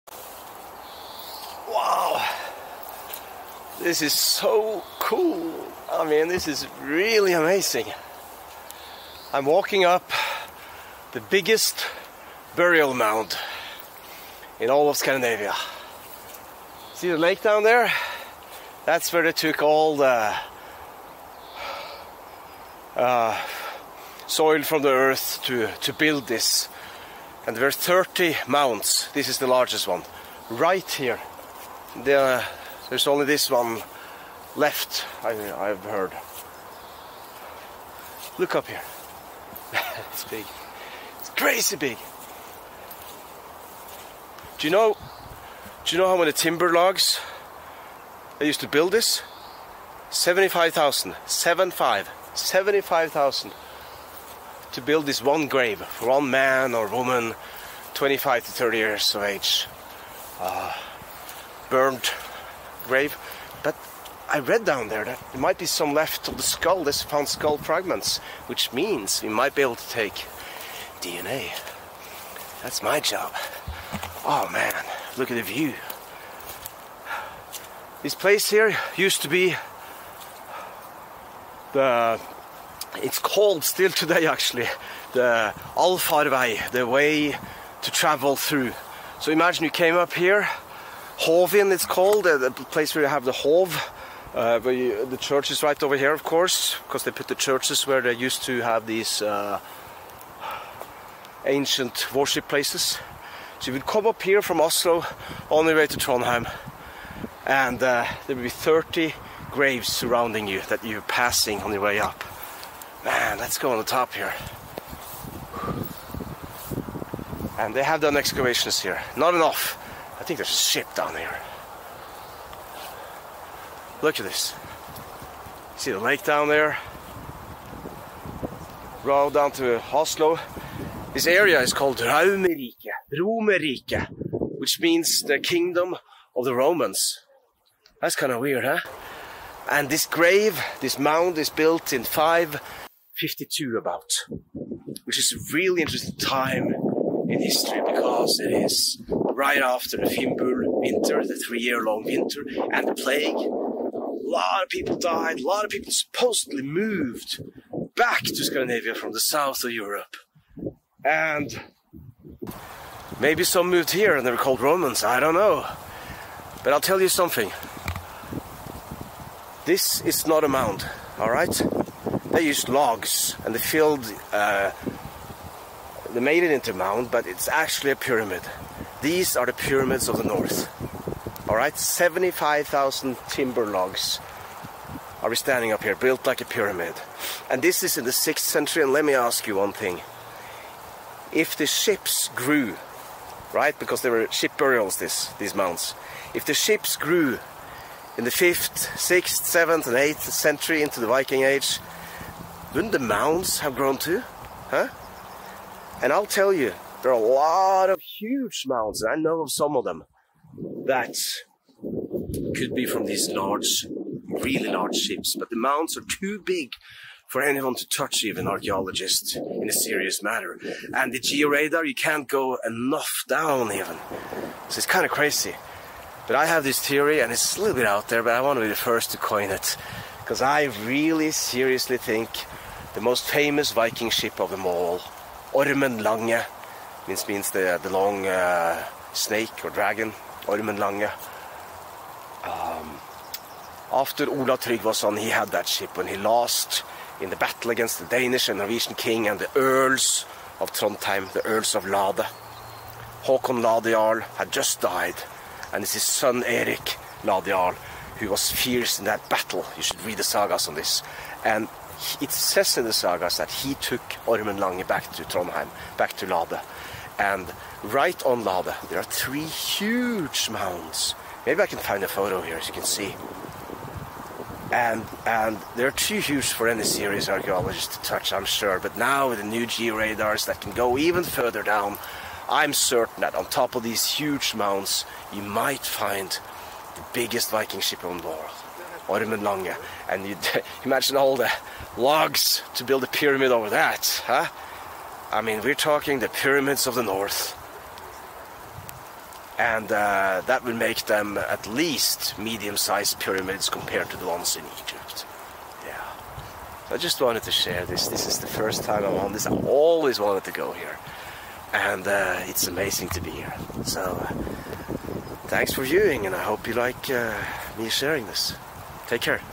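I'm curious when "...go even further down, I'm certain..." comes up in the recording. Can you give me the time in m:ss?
4:40.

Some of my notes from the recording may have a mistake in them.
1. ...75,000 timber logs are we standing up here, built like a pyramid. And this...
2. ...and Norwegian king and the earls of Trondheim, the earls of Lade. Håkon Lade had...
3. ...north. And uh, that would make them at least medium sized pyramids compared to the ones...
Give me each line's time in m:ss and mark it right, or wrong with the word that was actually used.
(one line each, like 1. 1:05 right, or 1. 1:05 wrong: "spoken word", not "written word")
1. 3:01 right
2. 4:08 right
3. 4:57 right.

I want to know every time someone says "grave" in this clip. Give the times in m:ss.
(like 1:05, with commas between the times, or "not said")
0:55, 1:02, 1:49, 2:20.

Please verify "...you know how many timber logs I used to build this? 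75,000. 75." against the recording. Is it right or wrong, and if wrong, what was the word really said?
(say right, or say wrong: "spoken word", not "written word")
right.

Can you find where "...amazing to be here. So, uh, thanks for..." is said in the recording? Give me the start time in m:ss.
5:12.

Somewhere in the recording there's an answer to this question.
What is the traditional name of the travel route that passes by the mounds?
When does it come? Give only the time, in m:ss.
1:25.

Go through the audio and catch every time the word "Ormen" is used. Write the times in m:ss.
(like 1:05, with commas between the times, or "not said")
3:55, 4:00, 4:24.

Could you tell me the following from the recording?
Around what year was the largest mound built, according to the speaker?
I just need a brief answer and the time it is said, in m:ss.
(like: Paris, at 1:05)
552, at 2:22.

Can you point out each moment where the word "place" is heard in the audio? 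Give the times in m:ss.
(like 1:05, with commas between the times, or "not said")
1:18, 1:32, 1:42.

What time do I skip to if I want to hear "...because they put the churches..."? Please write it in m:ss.
1:36.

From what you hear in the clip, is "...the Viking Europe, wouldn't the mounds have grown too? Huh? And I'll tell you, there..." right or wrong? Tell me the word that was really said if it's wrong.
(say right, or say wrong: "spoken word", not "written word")
wrong: "Age", not "Europe".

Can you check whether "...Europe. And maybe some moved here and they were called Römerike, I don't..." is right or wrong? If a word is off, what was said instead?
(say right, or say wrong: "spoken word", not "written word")
wrong: "Romans", not "Römerike".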